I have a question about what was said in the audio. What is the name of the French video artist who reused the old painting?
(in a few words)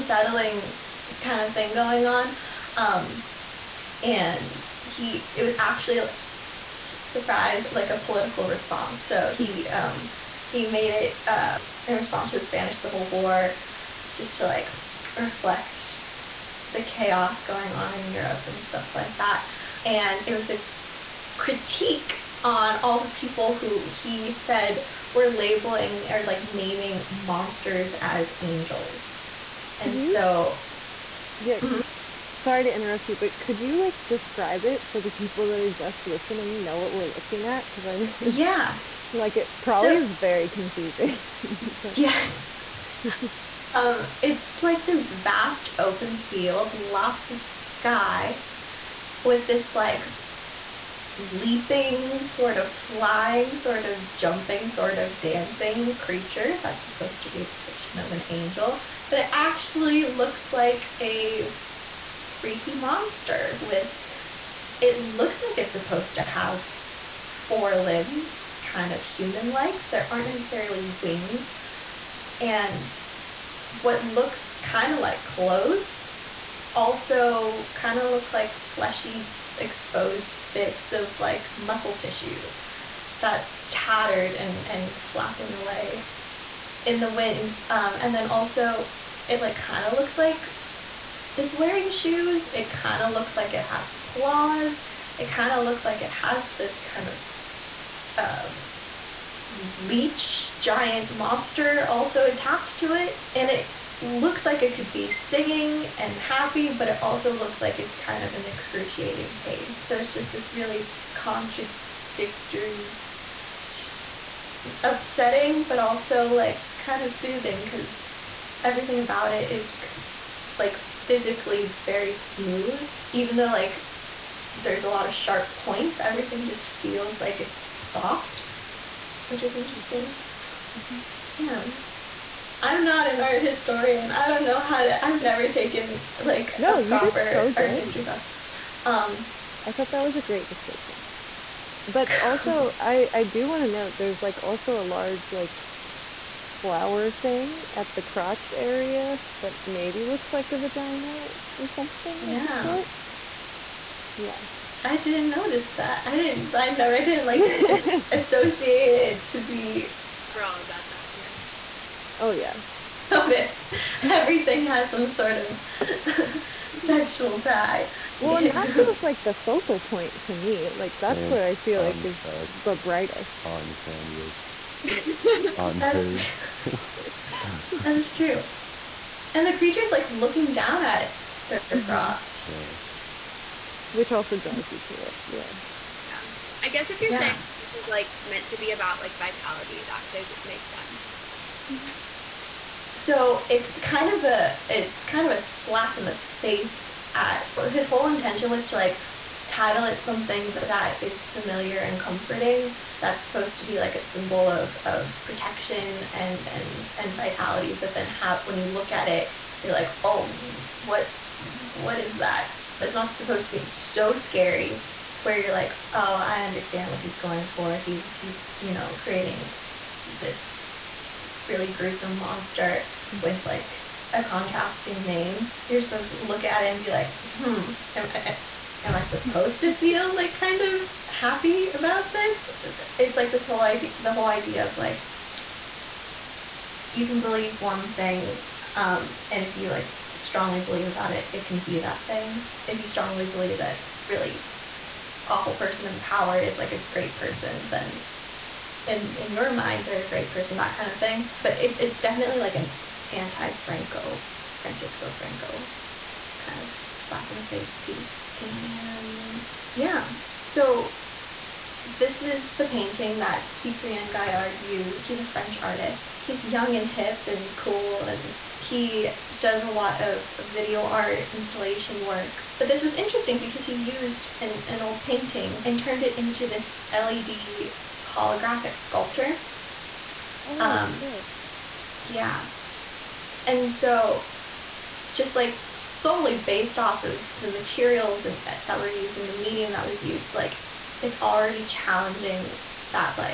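Cyprien Gaillard.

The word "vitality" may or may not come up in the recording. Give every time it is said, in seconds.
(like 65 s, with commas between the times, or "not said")
189 s, 207 s.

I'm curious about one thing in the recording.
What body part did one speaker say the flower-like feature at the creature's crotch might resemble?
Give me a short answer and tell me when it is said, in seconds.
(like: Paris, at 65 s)
vagina, at 150 s.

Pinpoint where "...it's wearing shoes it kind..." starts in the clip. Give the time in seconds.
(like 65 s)
91 s.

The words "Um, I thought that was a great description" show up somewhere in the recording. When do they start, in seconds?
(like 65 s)
138 s.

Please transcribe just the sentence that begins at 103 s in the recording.
And it looks like it could be singing and happy, but it also looks like it's kind of an excruciating pain.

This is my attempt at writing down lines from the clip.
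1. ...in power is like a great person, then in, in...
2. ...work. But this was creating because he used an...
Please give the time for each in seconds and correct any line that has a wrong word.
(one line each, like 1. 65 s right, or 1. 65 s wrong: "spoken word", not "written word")
1. 245 s right
2. 272 s wrong: "interesting", not "creating".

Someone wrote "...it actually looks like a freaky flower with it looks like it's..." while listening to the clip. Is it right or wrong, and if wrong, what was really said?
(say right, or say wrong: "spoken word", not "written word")
wrong: "monster", not "flower".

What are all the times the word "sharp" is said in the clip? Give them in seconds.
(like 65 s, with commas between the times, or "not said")
125 s.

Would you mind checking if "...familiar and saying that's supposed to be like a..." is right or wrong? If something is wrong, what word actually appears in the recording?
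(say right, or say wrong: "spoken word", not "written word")
wrong: "comforting", not "saying".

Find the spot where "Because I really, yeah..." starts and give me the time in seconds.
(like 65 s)
37 s.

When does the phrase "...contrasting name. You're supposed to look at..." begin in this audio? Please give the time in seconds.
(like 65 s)
224 s.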